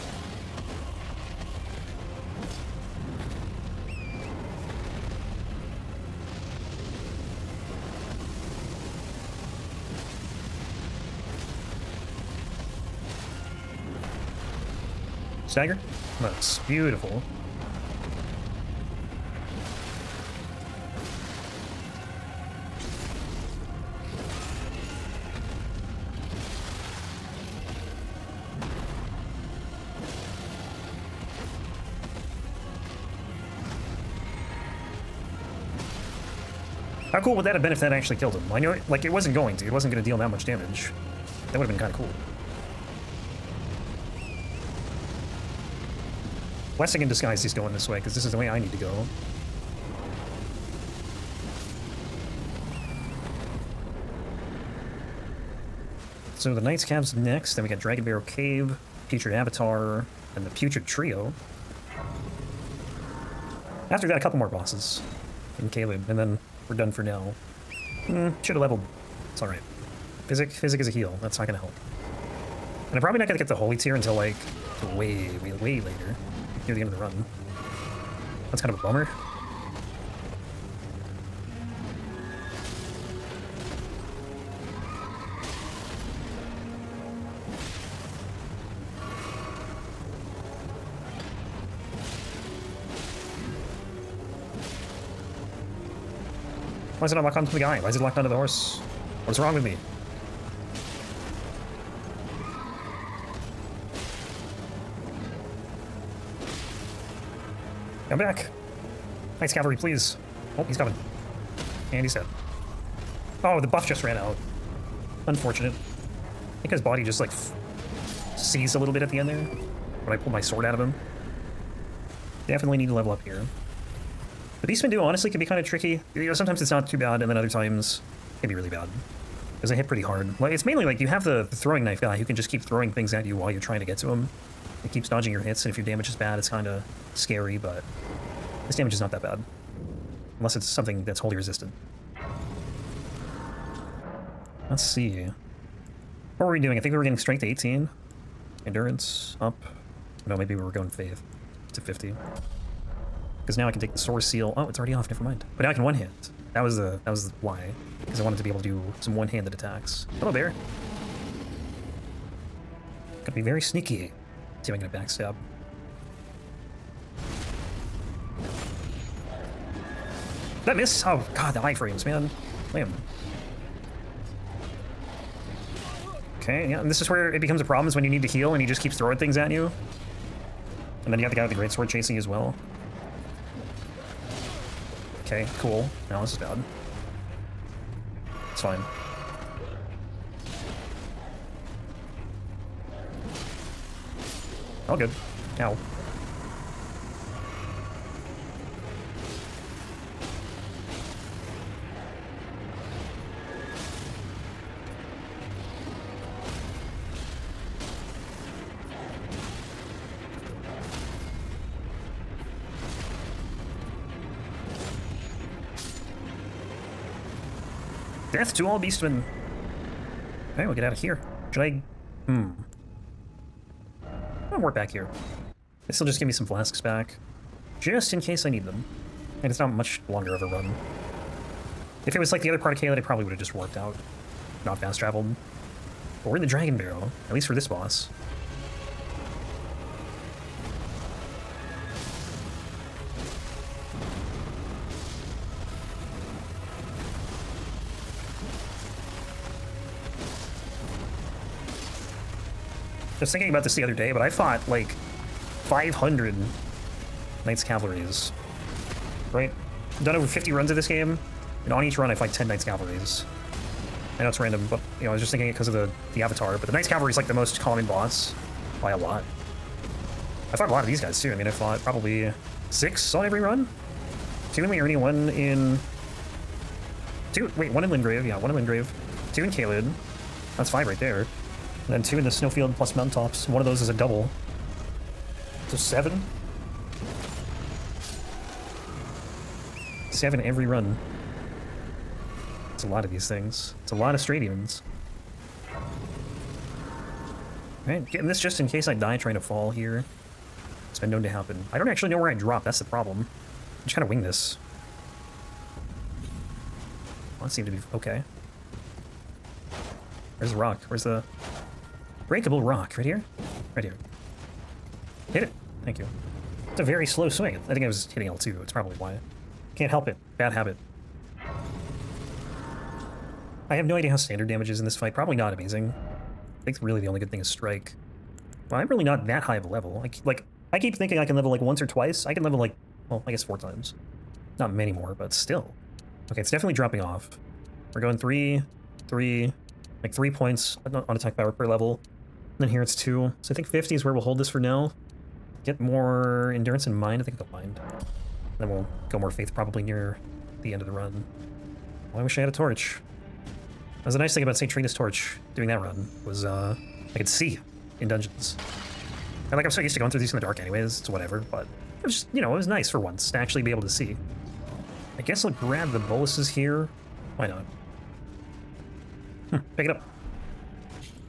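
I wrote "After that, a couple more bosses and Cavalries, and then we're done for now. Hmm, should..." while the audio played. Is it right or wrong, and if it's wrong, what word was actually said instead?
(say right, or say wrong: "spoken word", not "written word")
wrong: "Caelid", not "Cavalries".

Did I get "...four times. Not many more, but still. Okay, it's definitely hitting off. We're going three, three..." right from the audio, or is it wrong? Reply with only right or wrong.
wrong.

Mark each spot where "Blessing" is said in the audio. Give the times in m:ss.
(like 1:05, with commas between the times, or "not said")
0:46.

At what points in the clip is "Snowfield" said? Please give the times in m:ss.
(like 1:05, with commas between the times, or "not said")
4:42.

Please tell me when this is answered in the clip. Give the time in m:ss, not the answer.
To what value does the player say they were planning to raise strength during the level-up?
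2:27.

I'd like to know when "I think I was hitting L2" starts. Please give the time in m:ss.
5:17.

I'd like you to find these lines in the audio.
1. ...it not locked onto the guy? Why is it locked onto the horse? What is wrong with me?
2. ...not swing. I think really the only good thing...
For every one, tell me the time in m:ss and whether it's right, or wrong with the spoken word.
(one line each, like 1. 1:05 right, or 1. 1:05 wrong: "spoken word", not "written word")
1. 1:37 right
2. 5:25 wrong: "amazing", not "swing".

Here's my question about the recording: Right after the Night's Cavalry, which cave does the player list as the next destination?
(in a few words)
Dragon Barrow Cave.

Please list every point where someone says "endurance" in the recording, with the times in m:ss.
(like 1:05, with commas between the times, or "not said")
2:28, 5:46.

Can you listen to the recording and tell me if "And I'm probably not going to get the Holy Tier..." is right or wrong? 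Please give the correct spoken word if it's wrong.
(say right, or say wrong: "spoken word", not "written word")
right.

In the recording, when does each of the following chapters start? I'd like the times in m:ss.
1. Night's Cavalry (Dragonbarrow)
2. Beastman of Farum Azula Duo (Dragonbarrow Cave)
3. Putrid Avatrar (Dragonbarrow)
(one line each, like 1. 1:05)
1. 1:12
2. 2:42
3. 3:57.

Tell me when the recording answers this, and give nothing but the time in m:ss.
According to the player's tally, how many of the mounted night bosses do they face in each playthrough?
4:50.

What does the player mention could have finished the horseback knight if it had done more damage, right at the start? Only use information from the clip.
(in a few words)
Stagger.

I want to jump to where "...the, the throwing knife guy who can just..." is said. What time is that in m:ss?
2:11.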